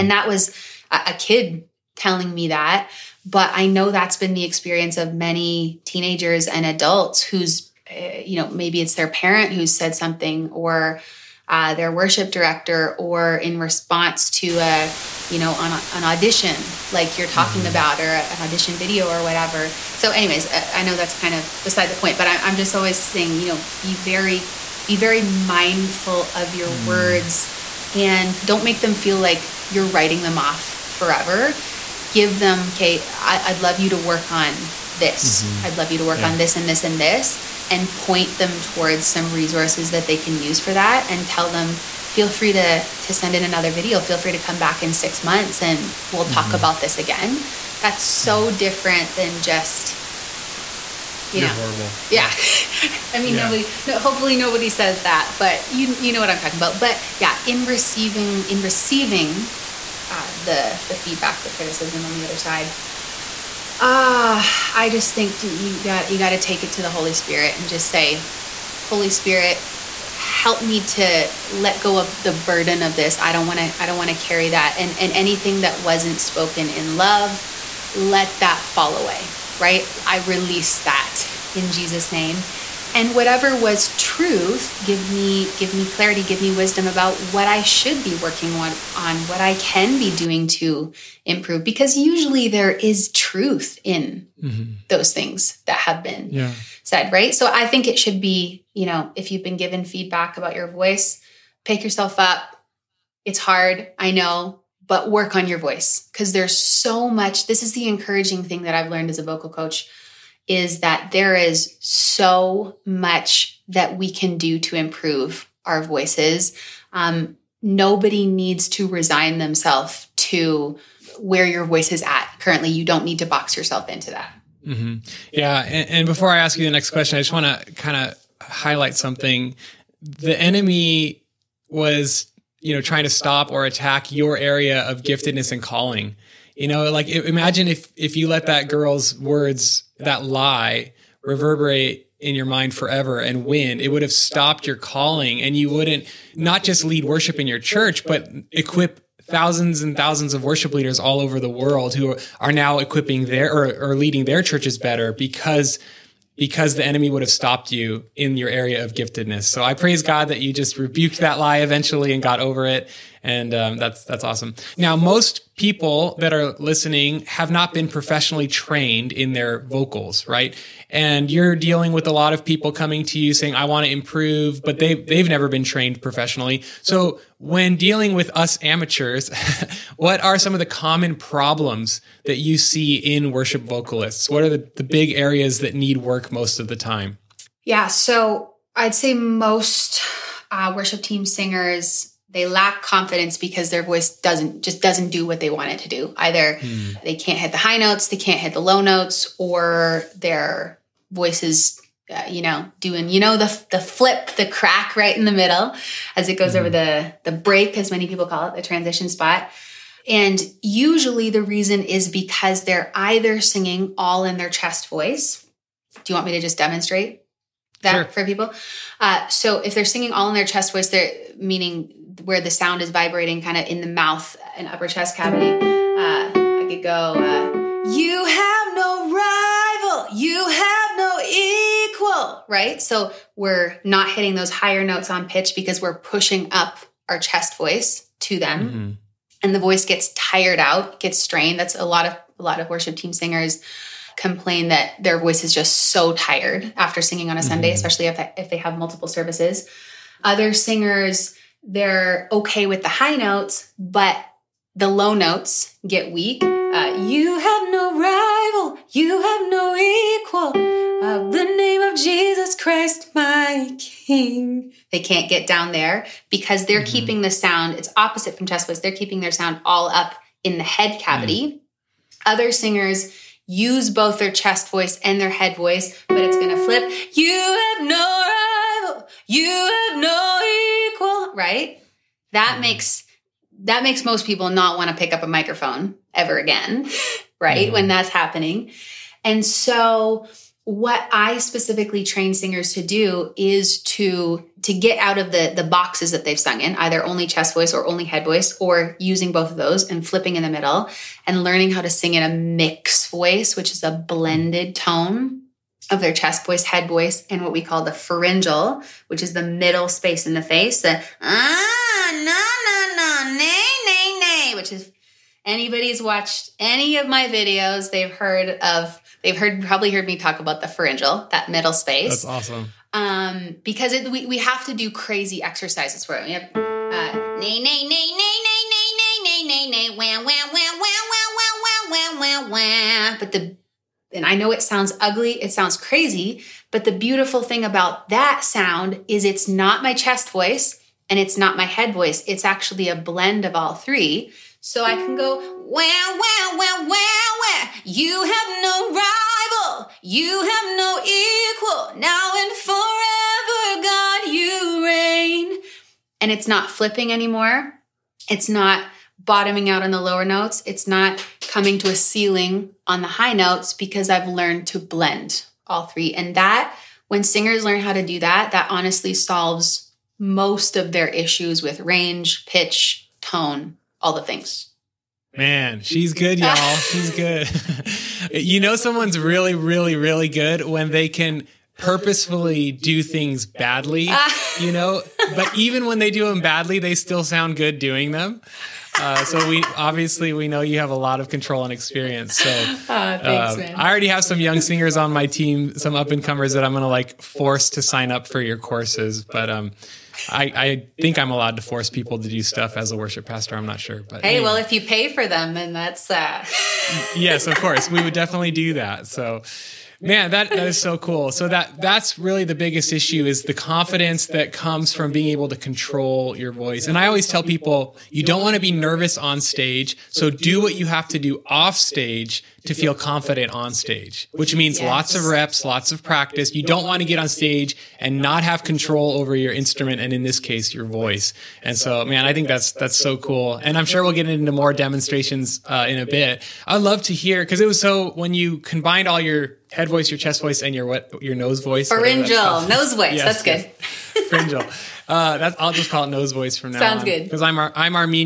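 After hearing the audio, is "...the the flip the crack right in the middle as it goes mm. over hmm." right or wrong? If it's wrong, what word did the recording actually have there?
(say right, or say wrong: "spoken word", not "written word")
right.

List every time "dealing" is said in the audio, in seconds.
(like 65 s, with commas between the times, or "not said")
171 s, 177 s.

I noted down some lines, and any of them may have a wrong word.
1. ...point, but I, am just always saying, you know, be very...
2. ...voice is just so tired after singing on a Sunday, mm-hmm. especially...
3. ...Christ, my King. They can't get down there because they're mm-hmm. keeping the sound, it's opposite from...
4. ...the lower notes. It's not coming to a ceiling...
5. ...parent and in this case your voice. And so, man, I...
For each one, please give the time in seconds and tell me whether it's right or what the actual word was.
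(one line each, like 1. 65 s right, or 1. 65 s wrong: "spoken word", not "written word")
1. 21 s right
2. 245 s right
3. 262 s right
4. 359 s right
5. 429 s wrong: "instrument", not "parent".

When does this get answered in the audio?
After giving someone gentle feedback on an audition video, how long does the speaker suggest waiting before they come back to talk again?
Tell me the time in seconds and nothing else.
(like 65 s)
44 s.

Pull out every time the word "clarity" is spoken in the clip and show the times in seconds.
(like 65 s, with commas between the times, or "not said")
85 s.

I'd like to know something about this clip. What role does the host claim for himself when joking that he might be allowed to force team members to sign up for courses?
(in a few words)
Worship pastor.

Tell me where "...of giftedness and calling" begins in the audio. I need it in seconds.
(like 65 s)
134 s.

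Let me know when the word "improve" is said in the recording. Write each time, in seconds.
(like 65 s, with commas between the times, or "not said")
91 s, 114 s, 173 s.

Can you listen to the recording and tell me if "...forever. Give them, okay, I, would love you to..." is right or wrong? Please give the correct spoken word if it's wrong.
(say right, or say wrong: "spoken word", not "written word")
right.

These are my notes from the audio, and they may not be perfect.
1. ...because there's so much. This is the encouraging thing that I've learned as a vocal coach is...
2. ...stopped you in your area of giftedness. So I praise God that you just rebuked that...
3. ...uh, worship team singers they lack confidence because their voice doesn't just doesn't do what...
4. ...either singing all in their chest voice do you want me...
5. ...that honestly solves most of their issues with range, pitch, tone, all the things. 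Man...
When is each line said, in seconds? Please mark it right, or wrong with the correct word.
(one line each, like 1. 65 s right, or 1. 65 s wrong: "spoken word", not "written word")
1. 106 s right
2. 157 s right
3. 190 s right
4. 212 s right
5. 368 s right.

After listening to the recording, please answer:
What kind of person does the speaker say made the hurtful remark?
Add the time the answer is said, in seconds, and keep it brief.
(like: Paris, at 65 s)
A kid, at 1 s.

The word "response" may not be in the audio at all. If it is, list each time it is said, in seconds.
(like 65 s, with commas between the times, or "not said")
13 s.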